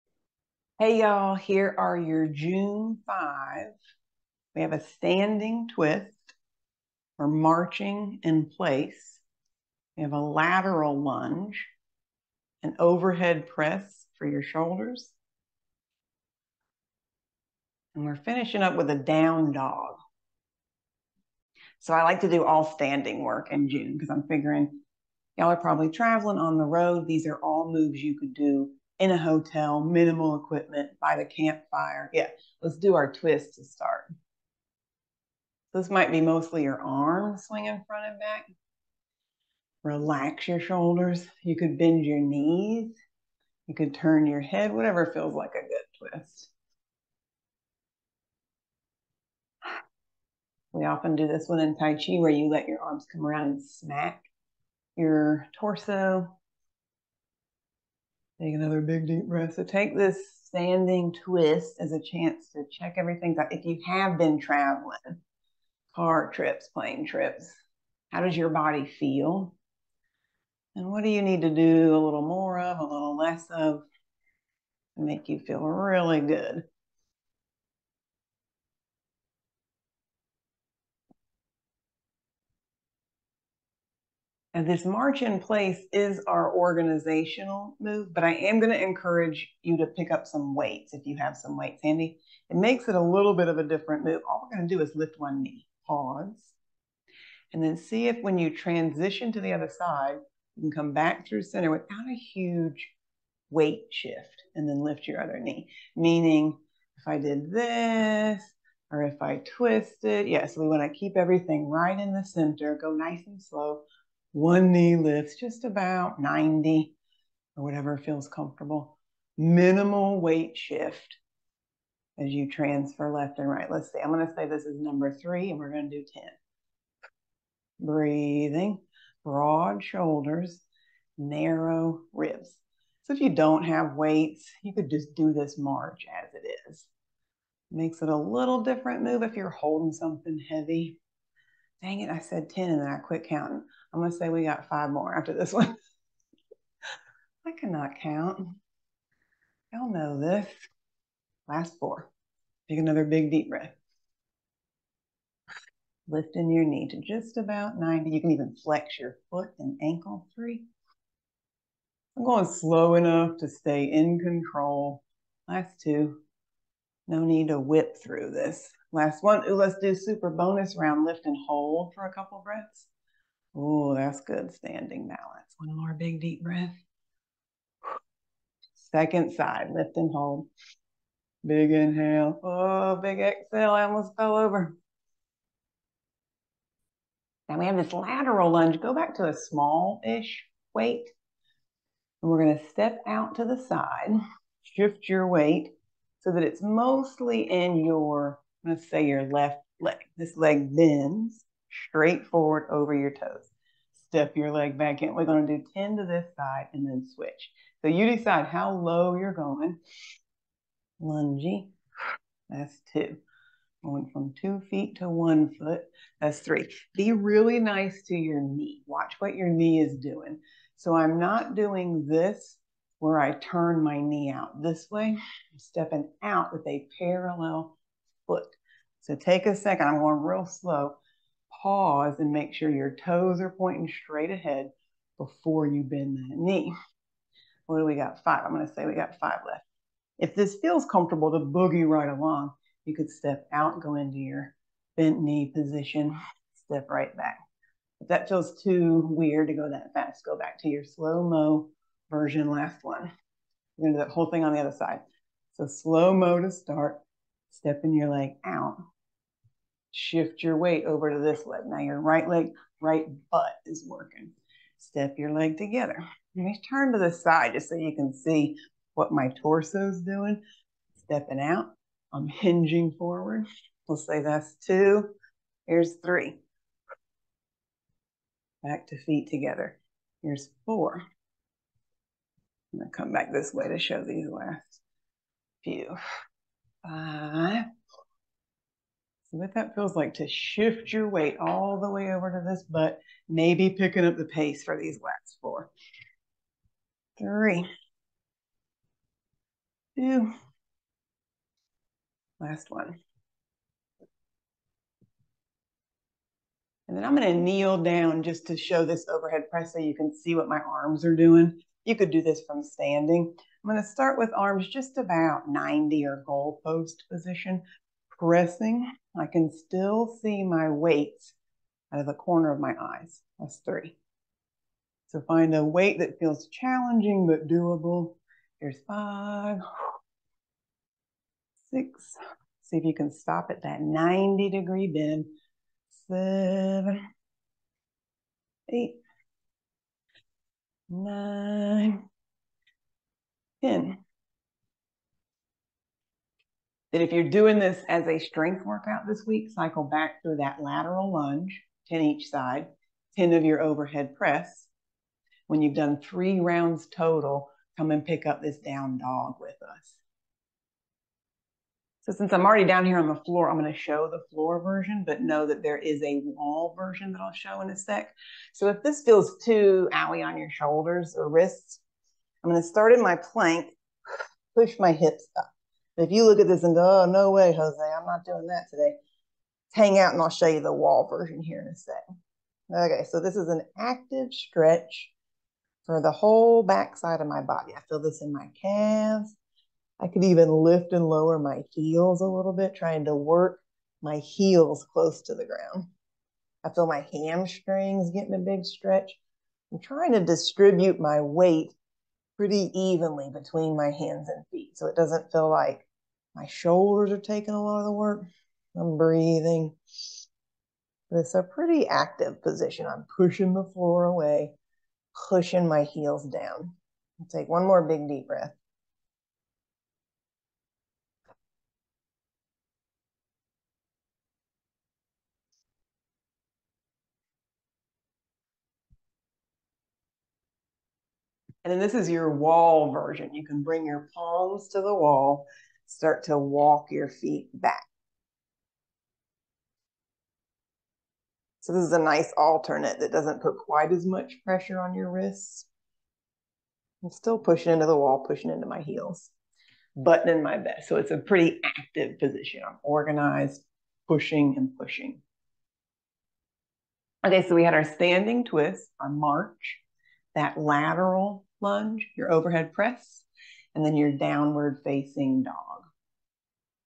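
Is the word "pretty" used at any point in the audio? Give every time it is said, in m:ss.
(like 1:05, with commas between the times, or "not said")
6:42, 6:51, 7:31.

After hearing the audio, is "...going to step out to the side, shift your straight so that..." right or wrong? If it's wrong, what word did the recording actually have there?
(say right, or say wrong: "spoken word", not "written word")
wrong: "weight", not "straight".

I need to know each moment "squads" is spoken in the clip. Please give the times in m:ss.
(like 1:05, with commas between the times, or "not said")
not said.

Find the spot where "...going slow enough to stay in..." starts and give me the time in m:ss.
2:42.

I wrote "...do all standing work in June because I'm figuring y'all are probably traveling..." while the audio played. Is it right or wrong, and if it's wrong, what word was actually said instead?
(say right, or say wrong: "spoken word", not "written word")
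right.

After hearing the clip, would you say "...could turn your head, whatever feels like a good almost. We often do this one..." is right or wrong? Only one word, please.
wrong.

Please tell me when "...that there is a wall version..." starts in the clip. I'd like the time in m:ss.
6:05.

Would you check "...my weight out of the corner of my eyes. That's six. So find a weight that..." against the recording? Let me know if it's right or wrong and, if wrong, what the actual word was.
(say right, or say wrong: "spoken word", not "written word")
wrong: "three", not "six".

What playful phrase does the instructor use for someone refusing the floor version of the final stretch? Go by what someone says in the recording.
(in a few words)
no way, Jose.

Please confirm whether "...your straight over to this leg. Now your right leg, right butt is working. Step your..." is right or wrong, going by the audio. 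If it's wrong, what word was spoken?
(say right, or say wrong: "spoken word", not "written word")
wrong: "weight", not "straight".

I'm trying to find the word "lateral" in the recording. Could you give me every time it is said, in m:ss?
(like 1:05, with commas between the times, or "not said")
0:10, 3:07, 5:50, 7:40.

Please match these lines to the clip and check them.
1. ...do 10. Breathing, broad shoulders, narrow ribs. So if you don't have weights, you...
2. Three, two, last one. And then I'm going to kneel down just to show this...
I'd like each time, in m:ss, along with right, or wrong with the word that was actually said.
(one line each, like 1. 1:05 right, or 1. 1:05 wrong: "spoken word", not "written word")
1. 2:05 right
2. 4:57 right.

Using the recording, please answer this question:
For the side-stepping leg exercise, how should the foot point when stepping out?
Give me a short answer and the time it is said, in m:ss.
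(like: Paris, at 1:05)
parallel, at 3:46.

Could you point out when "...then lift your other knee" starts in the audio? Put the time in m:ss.
1:44.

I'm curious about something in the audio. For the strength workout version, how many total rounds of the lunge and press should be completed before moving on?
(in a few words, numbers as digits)
3.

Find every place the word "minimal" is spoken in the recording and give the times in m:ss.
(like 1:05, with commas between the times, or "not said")
0:29, 1:59.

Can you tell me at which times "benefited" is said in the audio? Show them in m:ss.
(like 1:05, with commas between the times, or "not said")
not said.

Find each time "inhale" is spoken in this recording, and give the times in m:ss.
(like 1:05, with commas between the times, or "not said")
3:01.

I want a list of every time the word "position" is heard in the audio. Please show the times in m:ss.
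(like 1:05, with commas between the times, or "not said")
4:05, 5:17, 6:52, 7:32.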